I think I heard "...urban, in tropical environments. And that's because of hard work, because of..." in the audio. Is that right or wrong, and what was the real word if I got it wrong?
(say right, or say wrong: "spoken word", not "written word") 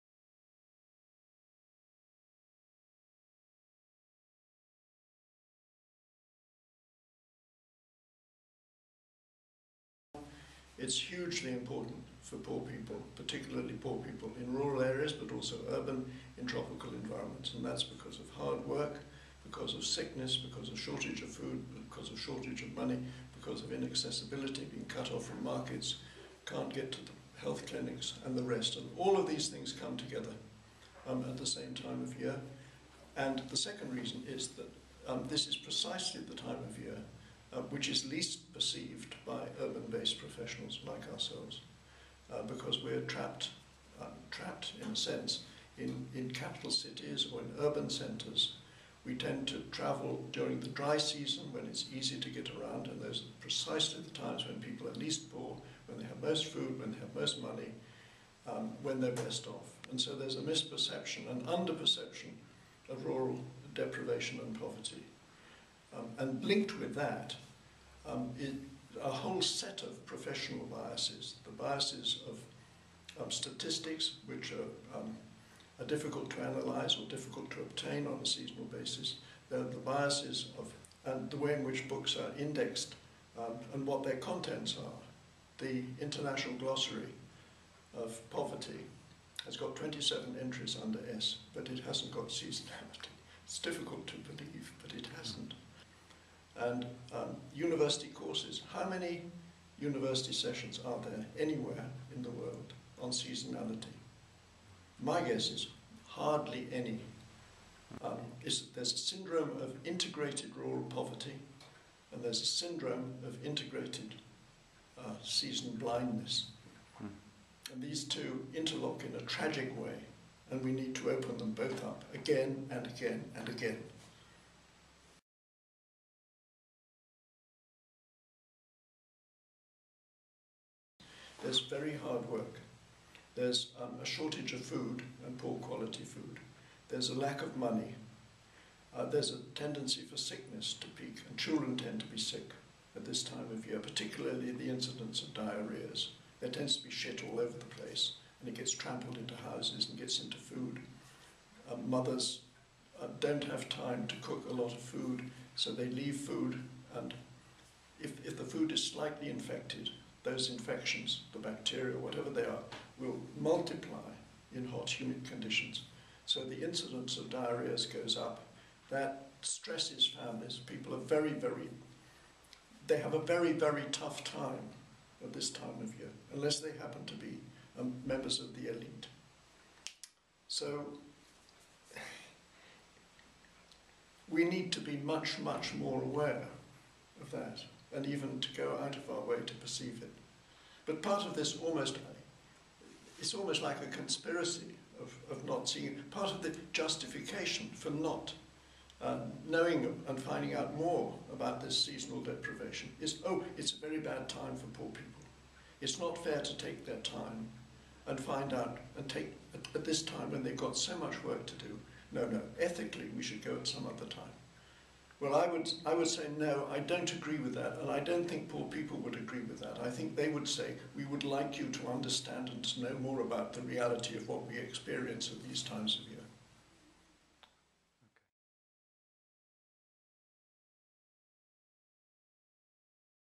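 right.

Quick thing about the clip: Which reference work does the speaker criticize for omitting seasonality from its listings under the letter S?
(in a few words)
International Glossary of Poverty.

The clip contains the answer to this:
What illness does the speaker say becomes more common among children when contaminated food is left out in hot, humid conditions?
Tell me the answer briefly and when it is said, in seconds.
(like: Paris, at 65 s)
diarrhea, at 167 s.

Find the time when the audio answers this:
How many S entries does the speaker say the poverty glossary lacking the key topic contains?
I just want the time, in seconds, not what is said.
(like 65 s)
89 s.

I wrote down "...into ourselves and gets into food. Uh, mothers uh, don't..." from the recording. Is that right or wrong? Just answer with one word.
wrong.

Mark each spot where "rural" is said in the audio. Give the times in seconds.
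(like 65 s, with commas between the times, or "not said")
14 s, 63 s, 110 s.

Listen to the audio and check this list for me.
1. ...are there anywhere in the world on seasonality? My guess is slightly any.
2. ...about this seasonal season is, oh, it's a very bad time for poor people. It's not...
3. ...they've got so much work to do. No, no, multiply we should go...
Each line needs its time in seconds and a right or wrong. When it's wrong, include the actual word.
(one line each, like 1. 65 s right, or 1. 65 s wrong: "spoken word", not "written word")
1. 100 s wrong: "hardly", not "slightly"
2. 201 s wrong: "deprivation", not "season"
3. 210 s wrong: "ethically", not "multiply".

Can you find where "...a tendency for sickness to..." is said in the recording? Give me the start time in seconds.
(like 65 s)
139 s.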